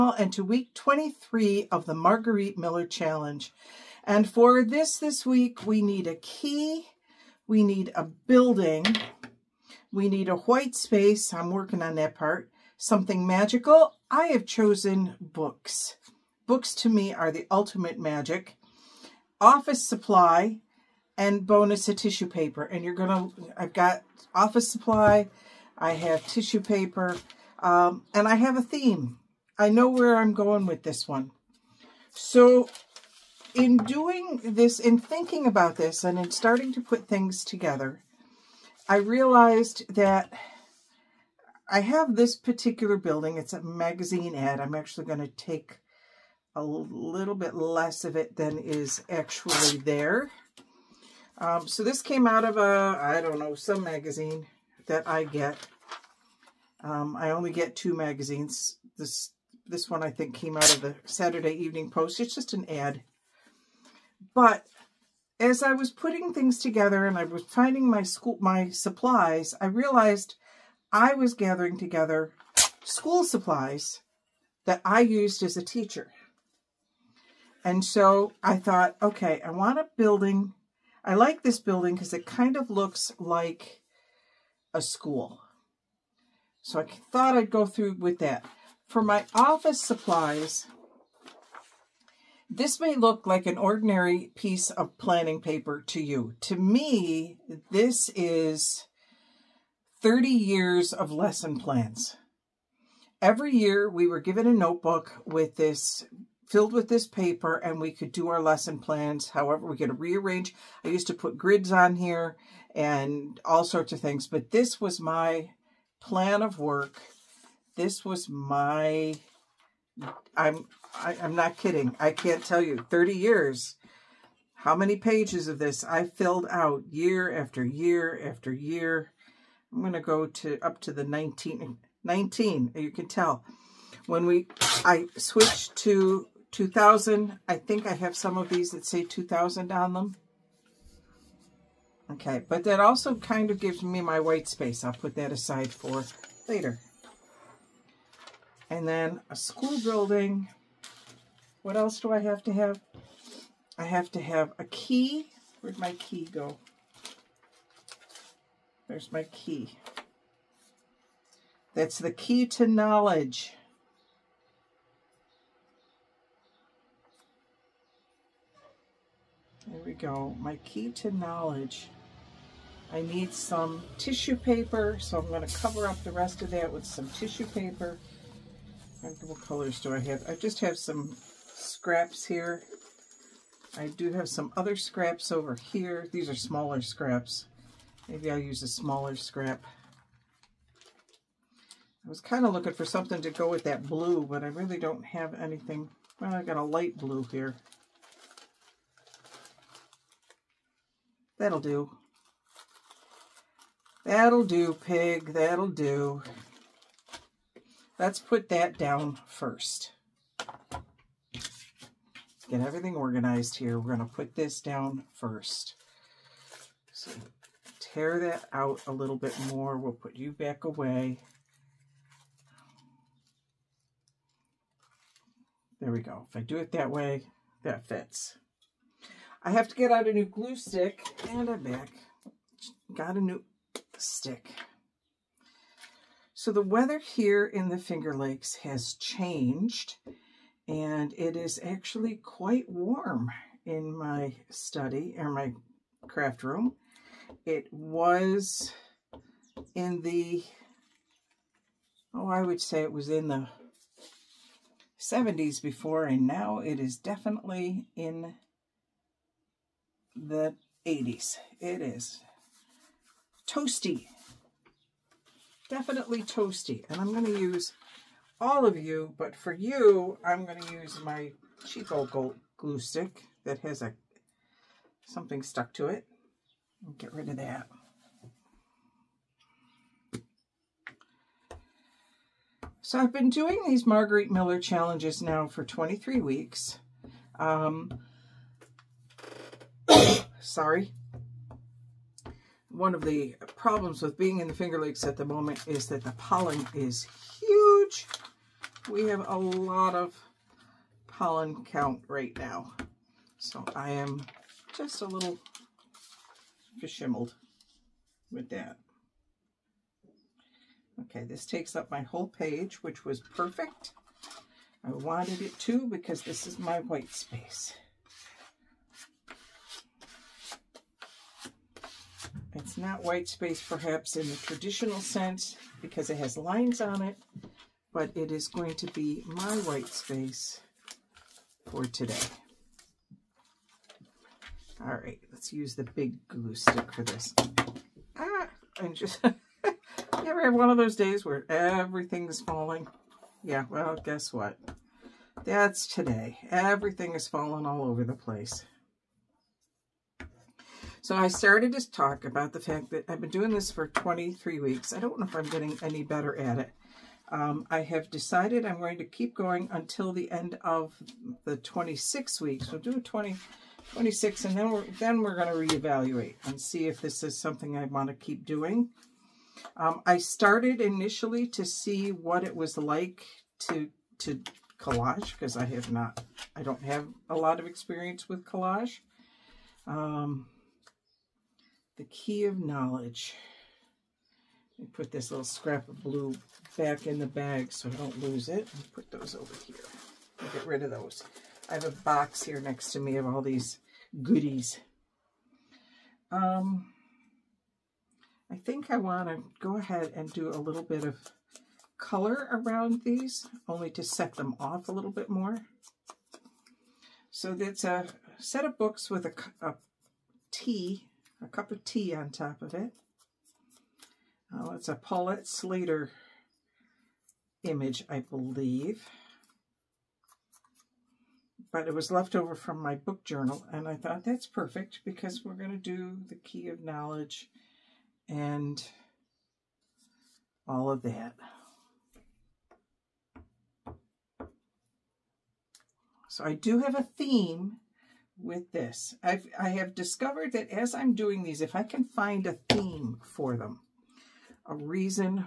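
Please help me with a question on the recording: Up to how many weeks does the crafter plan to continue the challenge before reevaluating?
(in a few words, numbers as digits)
26.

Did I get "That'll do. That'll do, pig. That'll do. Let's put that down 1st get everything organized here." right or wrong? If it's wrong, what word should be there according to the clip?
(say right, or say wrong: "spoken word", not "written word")
right.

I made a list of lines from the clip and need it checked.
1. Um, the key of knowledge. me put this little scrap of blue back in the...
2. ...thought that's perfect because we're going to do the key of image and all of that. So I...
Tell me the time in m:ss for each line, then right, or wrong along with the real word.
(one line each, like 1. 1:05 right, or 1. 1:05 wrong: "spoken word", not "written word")
1. 6:19 right
2. 7:03 wrong: "knowledge", not "image".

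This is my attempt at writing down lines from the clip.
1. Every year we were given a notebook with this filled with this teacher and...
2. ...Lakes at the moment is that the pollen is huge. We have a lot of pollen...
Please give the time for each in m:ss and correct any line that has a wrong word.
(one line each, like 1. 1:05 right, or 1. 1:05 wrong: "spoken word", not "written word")
1. 1:43 wrong: "paper", not "teacher"
2. 4:54 right.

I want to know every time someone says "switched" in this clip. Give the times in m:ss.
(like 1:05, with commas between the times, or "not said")
2:15.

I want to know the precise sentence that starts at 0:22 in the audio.
And you're going to, I've got office supply, I have tissue paper, um, and I have a theme.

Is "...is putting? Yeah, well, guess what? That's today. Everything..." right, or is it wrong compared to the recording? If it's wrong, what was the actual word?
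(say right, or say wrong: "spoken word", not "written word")
wrong: "falling", not "putting".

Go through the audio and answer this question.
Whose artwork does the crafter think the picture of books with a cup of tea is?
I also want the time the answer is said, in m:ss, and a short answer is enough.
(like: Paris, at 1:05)
Paulette Slater, at 6:54.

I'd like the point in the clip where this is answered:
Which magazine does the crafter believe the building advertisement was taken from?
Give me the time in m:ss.
1:01.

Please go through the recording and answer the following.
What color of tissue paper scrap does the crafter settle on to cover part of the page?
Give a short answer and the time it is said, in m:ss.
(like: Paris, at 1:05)
Light blue, at 3:16.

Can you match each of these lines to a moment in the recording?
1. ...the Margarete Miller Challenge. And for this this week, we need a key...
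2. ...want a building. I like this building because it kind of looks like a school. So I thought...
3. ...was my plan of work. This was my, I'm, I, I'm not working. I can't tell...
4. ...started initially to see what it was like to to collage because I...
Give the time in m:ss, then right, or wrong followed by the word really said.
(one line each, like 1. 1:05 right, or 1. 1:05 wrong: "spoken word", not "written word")
1. 0:01 right
2. 1:19 right
3. 1:54 wrong: "kidding", not "working"
4. 6:10 right.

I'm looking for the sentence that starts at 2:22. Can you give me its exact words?
Okay, but that also kind of gives me my white space.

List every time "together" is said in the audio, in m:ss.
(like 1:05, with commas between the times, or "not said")
0:37, 1:06, 1:11.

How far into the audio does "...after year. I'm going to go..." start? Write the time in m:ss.
2:08.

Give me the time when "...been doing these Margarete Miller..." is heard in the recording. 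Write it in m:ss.
4:43.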